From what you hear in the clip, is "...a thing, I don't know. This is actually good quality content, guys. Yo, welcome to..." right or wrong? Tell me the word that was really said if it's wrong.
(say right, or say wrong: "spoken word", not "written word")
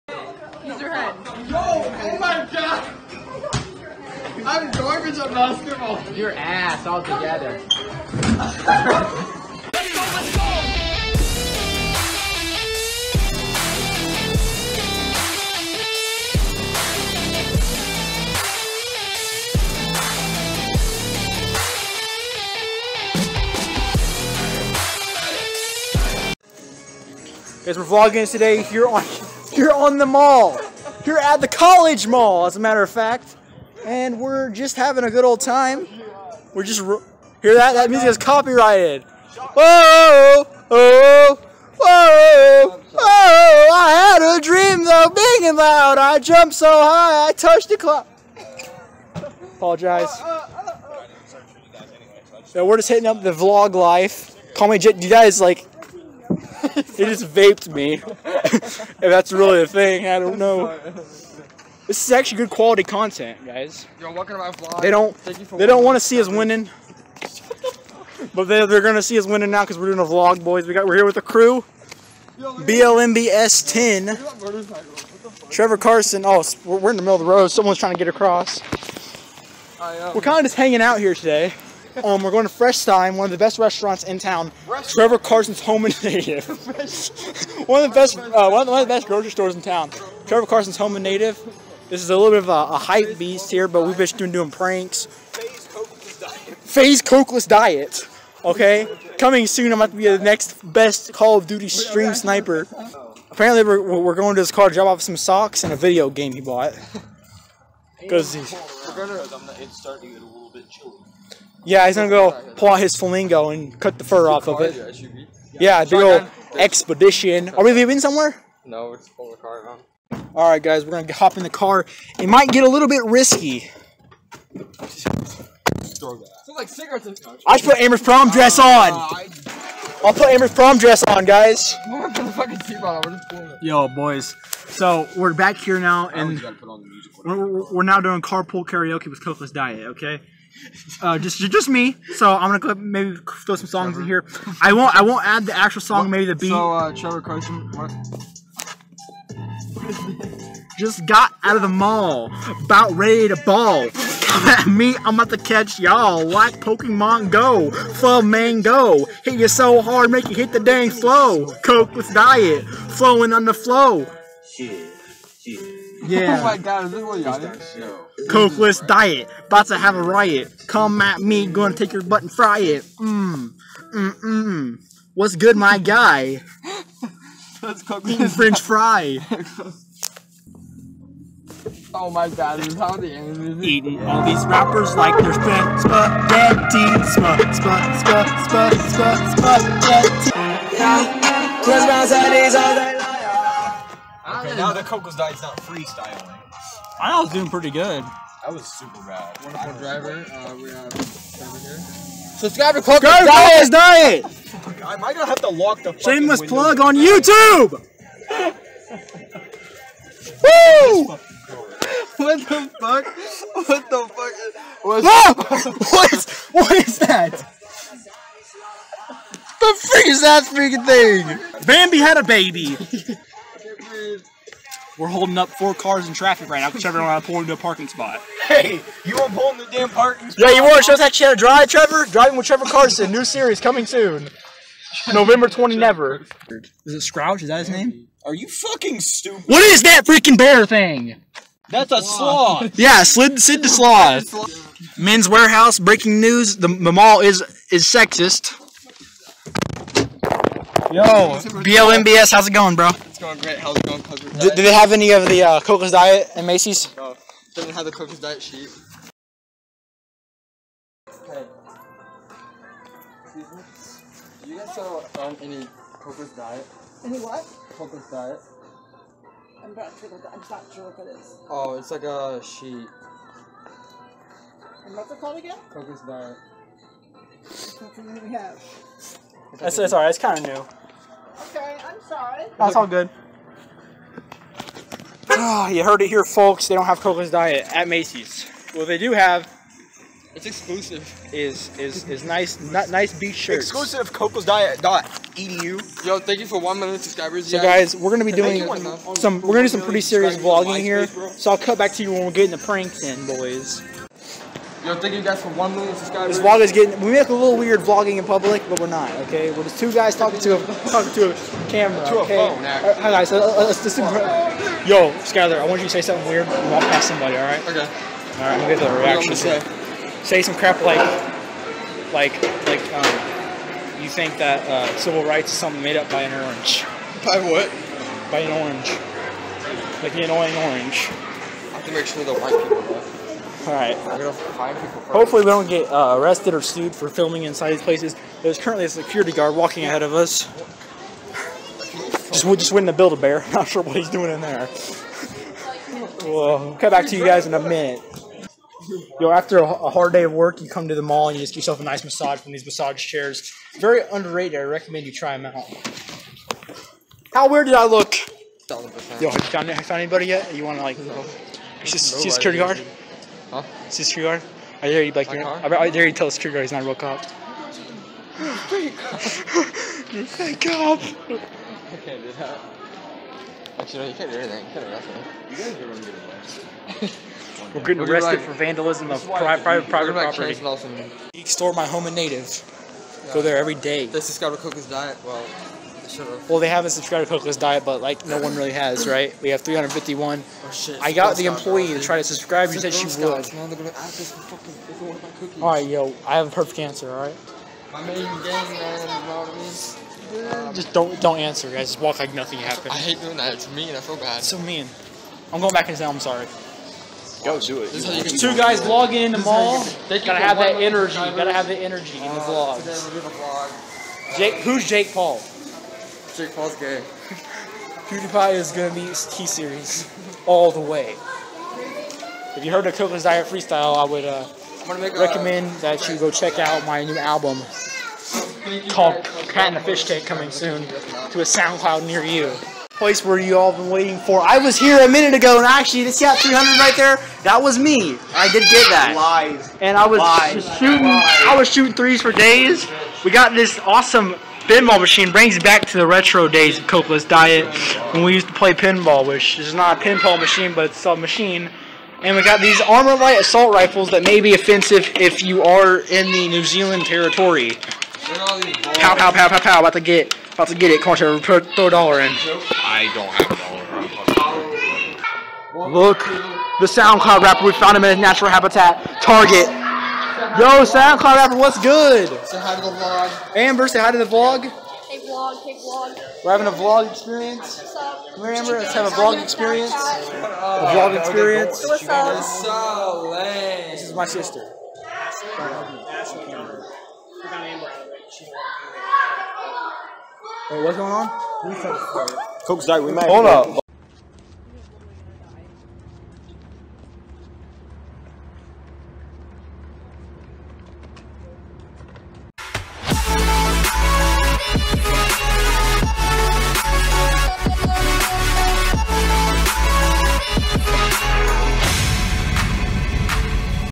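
right.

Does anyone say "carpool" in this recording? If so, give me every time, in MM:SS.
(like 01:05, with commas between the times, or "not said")
02:18.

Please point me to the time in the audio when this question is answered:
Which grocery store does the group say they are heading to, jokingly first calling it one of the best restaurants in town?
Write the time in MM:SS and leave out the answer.
01:22.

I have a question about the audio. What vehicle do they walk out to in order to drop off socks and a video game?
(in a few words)
Expedition.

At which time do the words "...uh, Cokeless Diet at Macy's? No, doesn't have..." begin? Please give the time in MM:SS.
04:15.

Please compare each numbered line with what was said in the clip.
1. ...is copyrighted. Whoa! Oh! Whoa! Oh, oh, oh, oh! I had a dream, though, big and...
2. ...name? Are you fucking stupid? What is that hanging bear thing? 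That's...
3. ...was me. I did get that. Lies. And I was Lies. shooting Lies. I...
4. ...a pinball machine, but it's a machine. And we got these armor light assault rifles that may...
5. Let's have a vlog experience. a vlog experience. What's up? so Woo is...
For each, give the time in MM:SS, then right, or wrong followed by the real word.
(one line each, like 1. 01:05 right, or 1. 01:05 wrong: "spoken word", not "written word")
1. 00:38 right
2. 03:57 wrong: "freaking", not "hanging"
3. 07:17 right
4. 07:29 right
5. 07:58 wrong: "This", not "Woo".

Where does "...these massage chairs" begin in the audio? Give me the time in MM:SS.
05:52.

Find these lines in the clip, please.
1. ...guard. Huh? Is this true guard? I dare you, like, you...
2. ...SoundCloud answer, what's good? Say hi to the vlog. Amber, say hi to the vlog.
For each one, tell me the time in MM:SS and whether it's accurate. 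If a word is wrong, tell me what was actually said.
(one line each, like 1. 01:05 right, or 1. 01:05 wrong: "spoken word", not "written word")
1. 06:02 right
2. 07:50 wrong: "rapper", not "answer".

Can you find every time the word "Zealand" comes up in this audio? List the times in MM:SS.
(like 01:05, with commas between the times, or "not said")
07:36.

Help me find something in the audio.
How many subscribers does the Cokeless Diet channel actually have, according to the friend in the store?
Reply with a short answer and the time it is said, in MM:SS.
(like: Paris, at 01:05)
351, at 06:29.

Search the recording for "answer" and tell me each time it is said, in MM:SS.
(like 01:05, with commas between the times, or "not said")
06:36, 06:41.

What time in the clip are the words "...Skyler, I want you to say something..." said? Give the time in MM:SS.
05:15.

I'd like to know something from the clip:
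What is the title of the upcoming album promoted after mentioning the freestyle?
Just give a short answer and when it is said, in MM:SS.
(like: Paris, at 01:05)
Cat and the Fish Tank, at 07:09.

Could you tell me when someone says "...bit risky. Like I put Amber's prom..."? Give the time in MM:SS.
02:02.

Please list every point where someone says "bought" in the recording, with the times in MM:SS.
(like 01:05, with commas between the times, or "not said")
01:46.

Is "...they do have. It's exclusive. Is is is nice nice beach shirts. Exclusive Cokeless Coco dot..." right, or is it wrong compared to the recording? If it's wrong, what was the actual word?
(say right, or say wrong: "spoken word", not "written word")
wrong: "Diet", not "Coco".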